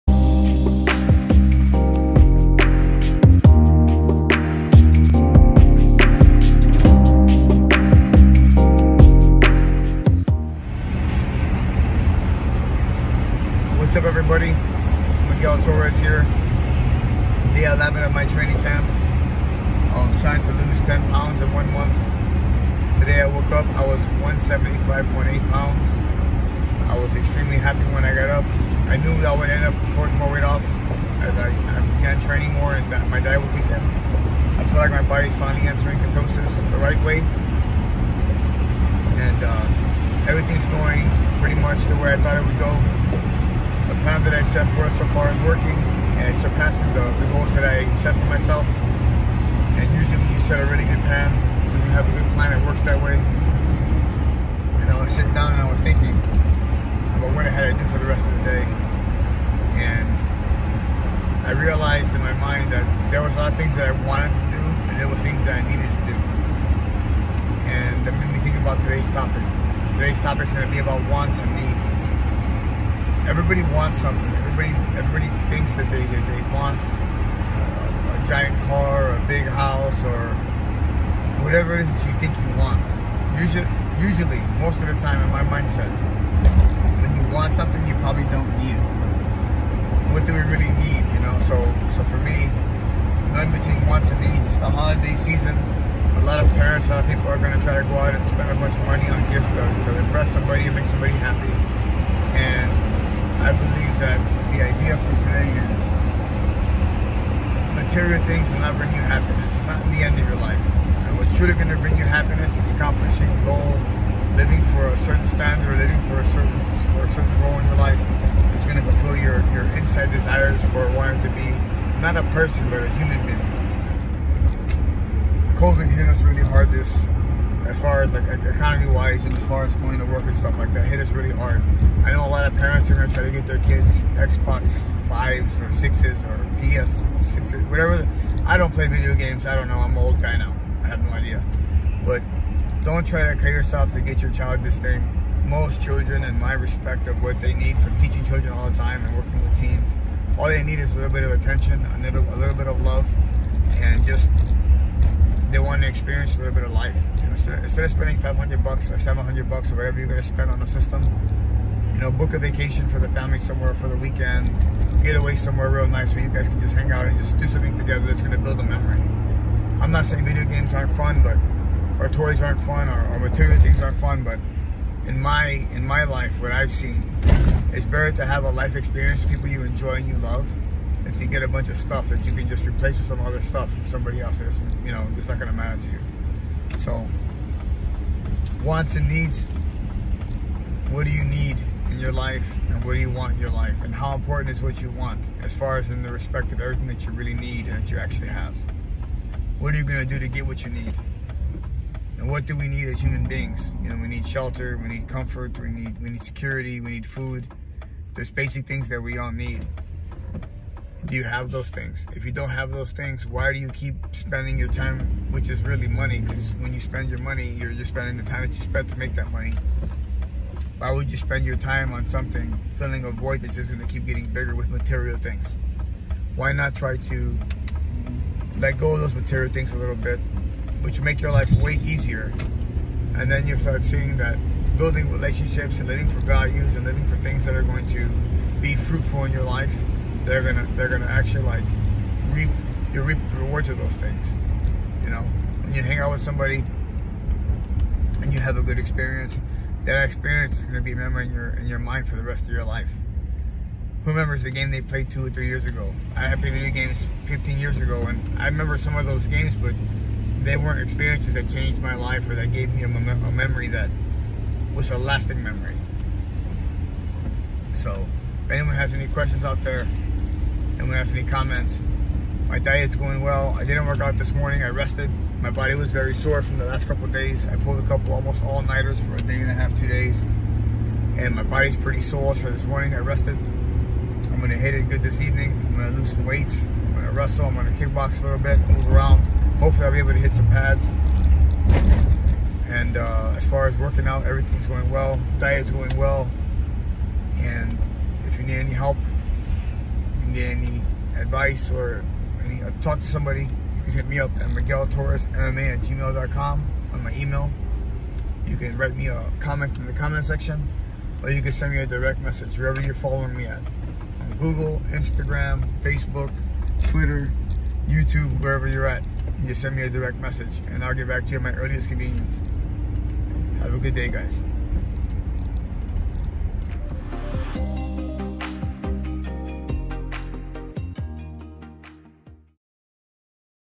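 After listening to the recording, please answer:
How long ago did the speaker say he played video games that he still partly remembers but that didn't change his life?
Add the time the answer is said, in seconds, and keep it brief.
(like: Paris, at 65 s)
15 years ago, at 257 s.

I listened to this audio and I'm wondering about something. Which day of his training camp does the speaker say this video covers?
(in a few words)
Day 11.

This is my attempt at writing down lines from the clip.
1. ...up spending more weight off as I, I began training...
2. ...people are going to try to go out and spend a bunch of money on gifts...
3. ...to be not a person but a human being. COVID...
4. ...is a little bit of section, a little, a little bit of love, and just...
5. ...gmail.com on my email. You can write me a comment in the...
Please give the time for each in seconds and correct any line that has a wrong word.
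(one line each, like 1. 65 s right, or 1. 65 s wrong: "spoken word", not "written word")
1. 29 s wrong: "throwing", not "spending"
2. 97 s right
3. 121 s right
4. 150 s wrong: "attention", not "section"
5. 305 s right.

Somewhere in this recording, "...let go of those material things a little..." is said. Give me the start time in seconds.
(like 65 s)
228 s.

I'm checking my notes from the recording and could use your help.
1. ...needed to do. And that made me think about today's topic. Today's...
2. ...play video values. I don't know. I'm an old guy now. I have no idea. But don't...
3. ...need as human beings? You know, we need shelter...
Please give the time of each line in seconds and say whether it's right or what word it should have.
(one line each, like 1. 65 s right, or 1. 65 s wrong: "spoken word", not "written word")
1. 65 s right
2. 138 s wrong: "games", not "values"
3. 202 s right.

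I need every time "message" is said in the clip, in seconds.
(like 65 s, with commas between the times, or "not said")
312 s, 320 s.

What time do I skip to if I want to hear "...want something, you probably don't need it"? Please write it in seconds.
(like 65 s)
87 s.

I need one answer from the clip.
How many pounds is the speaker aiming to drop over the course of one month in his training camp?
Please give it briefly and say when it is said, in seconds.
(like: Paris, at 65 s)
10 pounds, at 20 s.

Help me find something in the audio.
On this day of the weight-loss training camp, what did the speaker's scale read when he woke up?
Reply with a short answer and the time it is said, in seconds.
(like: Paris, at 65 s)
175.8 pounds, at 24 s.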